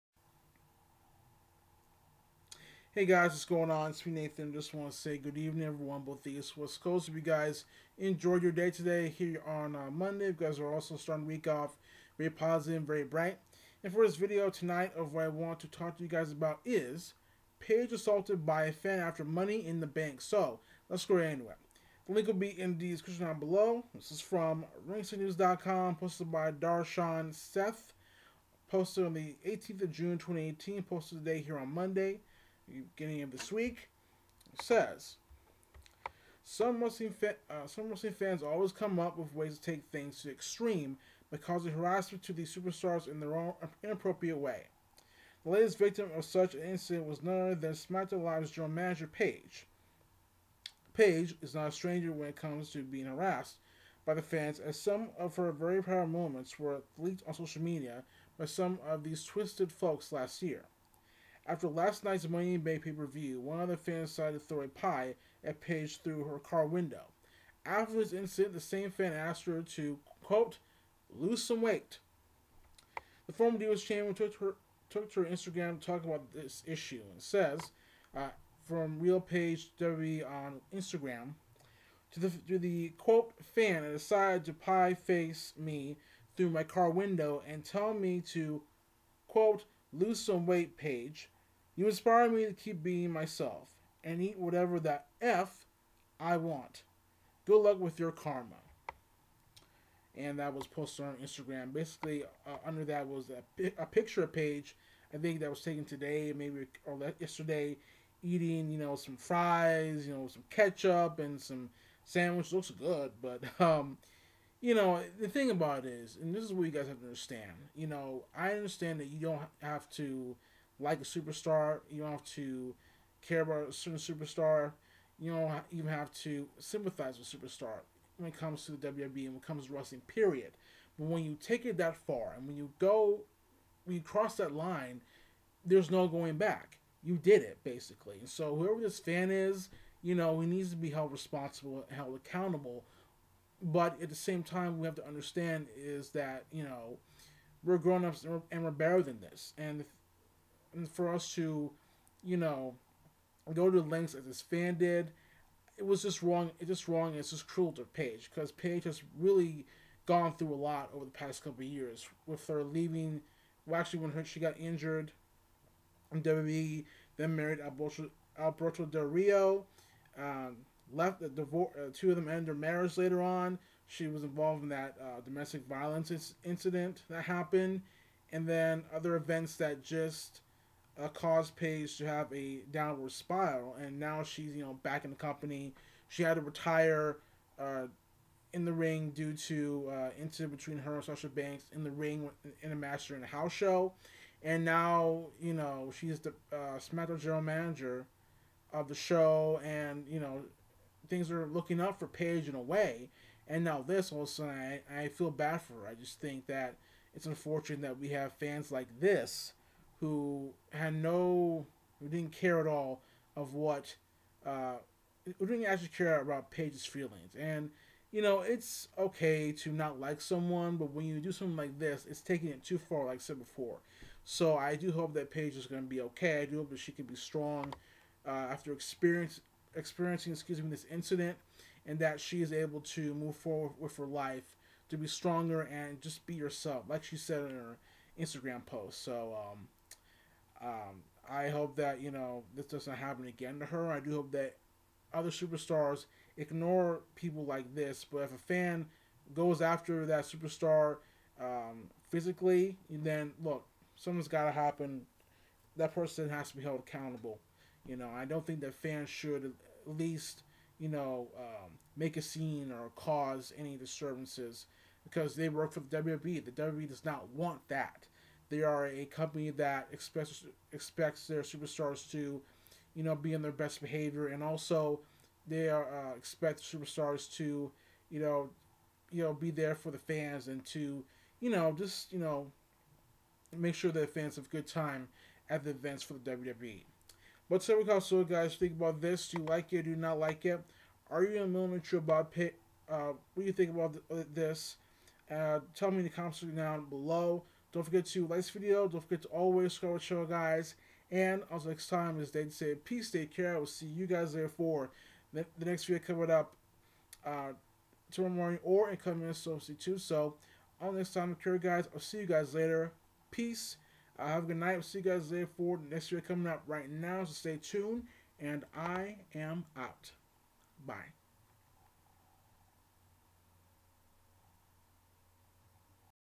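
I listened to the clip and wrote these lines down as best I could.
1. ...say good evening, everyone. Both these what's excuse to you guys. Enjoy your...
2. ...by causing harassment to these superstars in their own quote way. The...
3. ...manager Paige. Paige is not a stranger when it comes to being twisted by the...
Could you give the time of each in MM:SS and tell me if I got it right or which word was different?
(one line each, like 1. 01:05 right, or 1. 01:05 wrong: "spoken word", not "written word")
1. 00:04 wrong: "close", not "excuse"
2. 00:41 wrong: "inappropriate", not "quote"
3. 00:48 wrong: "harassed", not "twisted".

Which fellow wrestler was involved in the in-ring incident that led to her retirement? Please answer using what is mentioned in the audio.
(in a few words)
Sasha Banks.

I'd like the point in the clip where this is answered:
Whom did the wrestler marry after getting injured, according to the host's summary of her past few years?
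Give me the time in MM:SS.
02:48.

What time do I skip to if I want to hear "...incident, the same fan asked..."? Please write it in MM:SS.
01:08.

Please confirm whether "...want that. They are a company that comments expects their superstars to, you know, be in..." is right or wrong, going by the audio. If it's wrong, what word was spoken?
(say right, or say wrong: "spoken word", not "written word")
wrong: "expects", not "comments".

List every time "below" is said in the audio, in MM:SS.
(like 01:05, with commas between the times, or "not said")
00:23, 04:56.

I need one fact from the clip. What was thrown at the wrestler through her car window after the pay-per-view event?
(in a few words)
A pie.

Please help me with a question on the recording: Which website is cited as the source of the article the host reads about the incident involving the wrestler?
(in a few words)
RingsideNews.com.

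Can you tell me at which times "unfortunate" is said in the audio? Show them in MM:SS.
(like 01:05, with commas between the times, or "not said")
03:27.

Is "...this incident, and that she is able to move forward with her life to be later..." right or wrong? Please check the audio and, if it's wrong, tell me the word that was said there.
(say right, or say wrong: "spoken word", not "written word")
wrong: "stronger", not "later".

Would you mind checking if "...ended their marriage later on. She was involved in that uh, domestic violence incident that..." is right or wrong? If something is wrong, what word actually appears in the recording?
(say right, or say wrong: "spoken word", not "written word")
right.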